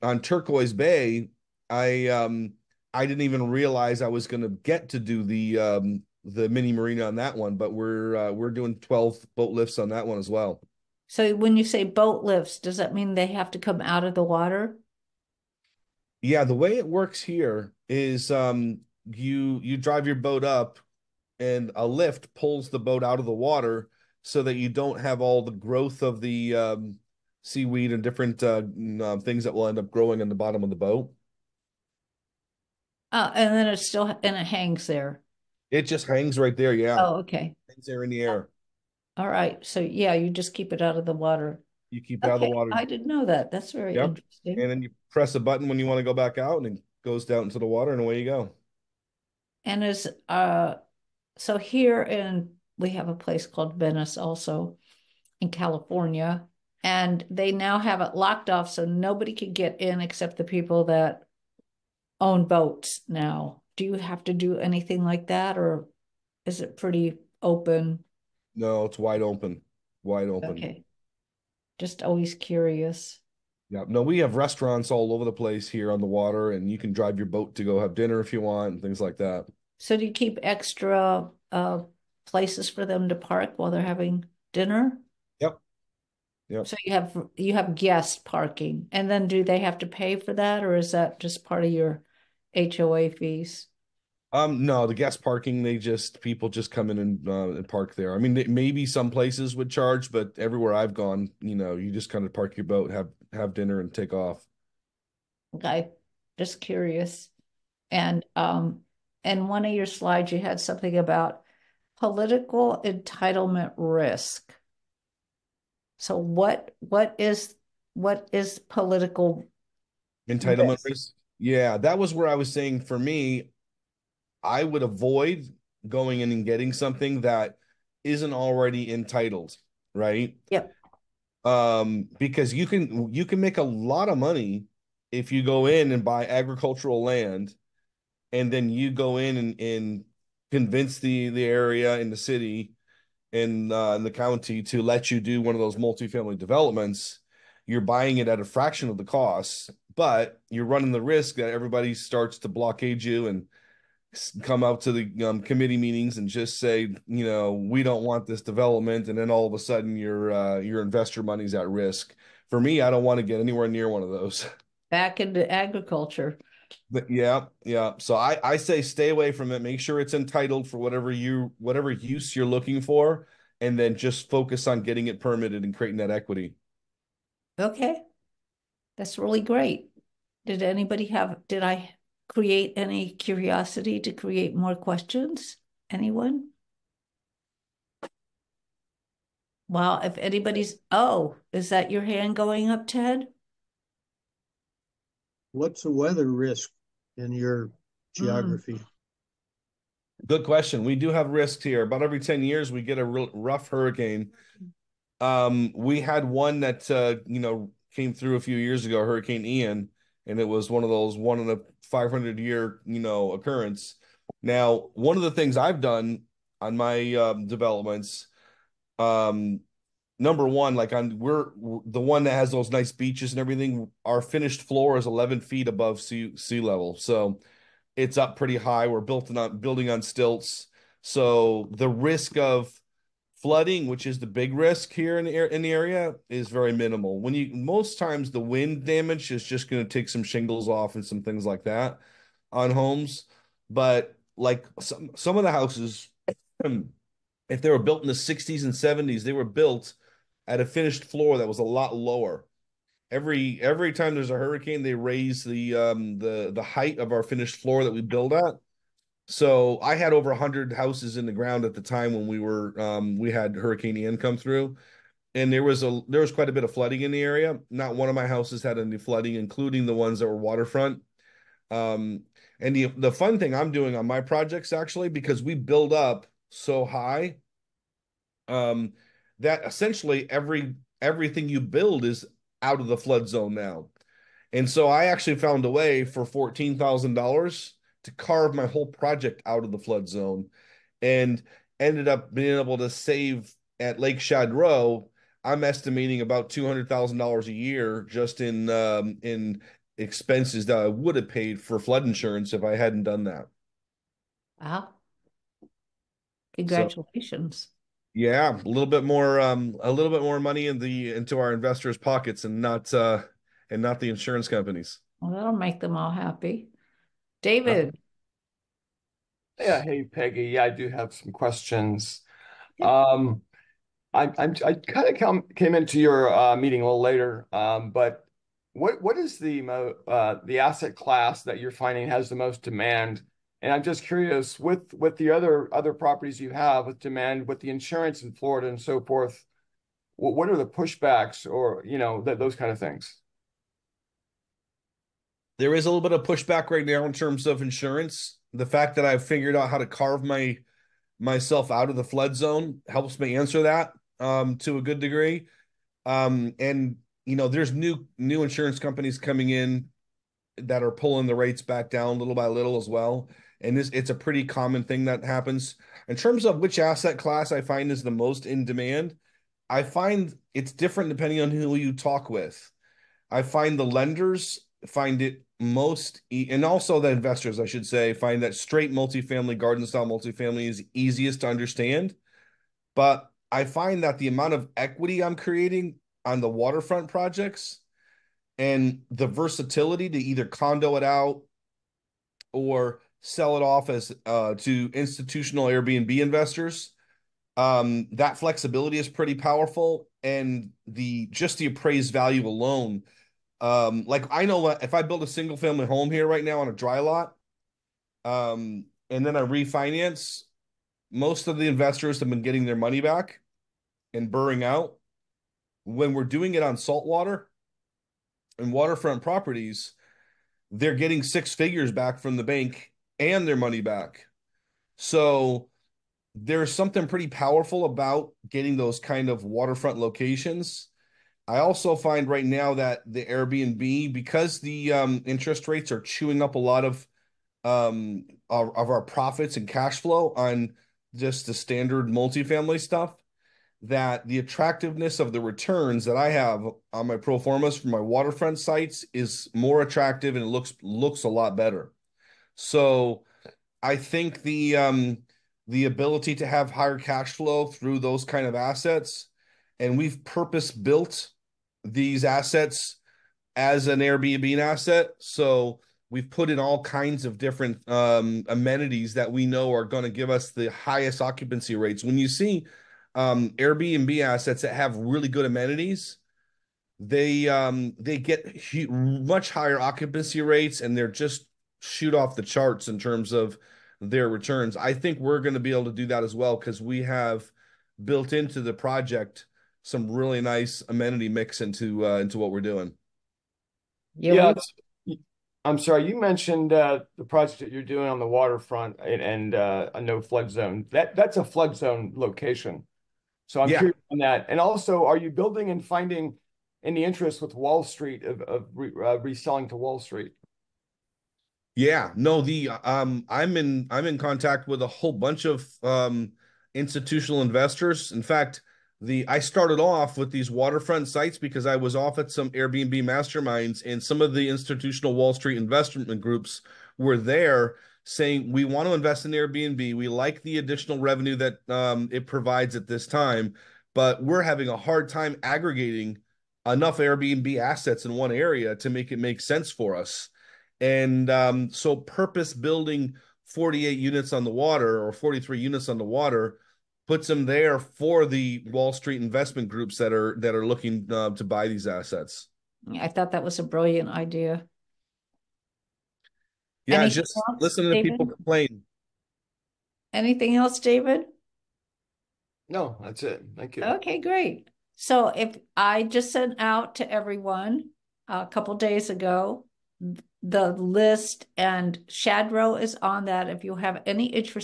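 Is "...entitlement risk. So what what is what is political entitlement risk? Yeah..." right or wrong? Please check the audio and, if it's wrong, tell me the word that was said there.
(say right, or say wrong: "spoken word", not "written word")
right.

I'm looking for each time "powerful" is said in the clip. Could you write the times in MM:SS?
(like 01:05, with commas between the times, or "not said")
06:39, 07:07.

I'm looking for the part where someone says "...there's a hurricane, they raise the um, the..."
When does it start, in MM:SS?
04:14.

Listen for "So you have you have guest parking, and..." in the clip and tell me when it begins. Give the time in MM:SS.
01:26.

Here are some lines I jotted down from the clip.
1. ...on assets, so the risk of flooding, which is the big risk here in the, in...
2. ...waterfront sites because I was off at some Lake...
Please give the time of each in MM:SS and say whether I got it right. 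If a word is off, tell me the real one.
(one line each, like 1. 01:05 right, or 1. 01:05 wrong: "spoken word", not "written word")
1. 03:49 wrong: "stilts", not "assets"
2. 08:40 wrong: "Airbnb", not "Lake".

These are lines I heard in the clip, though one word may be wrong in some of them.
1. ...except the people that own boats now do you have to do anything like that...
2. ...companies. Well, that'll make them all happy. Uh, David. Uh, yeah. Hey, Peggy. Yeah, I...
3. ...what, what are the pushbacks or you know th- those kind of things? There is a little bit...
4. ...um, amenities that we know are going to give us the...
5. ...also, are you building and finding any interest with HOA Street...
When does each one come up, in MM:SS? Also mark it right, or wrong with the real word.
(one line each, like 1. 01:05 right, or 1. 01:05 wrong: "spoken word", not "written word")
1. 01:00 right
2. 05:14 right
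3. 05:40 right
4. 07:47 right
5. 08:24 wrong: "Wall", not "HOA".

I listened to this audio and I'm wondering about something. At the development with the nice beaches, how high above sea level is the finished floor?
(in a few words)
11 feet.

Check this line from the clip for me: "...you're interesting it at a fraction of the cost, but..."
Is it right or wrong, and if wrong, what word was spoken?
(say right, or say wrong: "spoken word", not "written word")
wrong: "buying", not "interesting".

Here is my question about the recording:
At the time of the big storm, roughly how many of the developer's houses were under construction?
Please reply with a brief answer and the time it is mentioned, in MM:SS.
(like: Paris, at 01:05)
over 100, at 04:20.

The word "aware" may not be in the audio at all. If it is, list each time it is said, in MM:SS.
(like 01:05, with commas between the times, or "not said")
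not said.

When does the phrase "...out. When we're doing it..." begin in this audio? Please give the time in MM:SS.
06:54.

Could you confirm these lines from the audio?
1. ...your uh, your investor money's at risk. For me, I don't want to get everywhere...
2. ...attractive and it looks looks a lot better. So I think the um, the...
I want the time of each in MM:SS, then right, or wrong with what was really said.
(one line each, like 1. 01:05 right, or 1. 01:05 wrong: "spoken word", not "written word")
1. 02:39 wrong: "anywhere", not "everywhere"
2. 07:29 right.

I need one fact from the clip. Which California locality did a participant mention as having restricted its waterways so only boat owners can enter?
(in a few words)
Venice.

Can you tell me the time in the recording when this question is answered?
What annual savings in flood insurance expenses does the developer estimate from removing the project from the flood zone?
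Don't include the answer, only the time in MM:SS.
04:56.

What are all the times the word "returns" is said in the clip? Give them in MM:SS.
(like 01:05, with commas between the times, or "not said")
07:25, 08:04.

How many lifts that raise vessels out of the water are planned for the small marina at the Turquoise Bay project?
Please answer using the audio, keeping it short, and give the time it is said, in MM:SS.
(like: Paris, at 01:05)
12, at 00:08.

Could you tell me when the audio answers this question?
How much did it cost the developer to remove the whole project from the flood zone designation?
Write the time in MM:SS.
04:46.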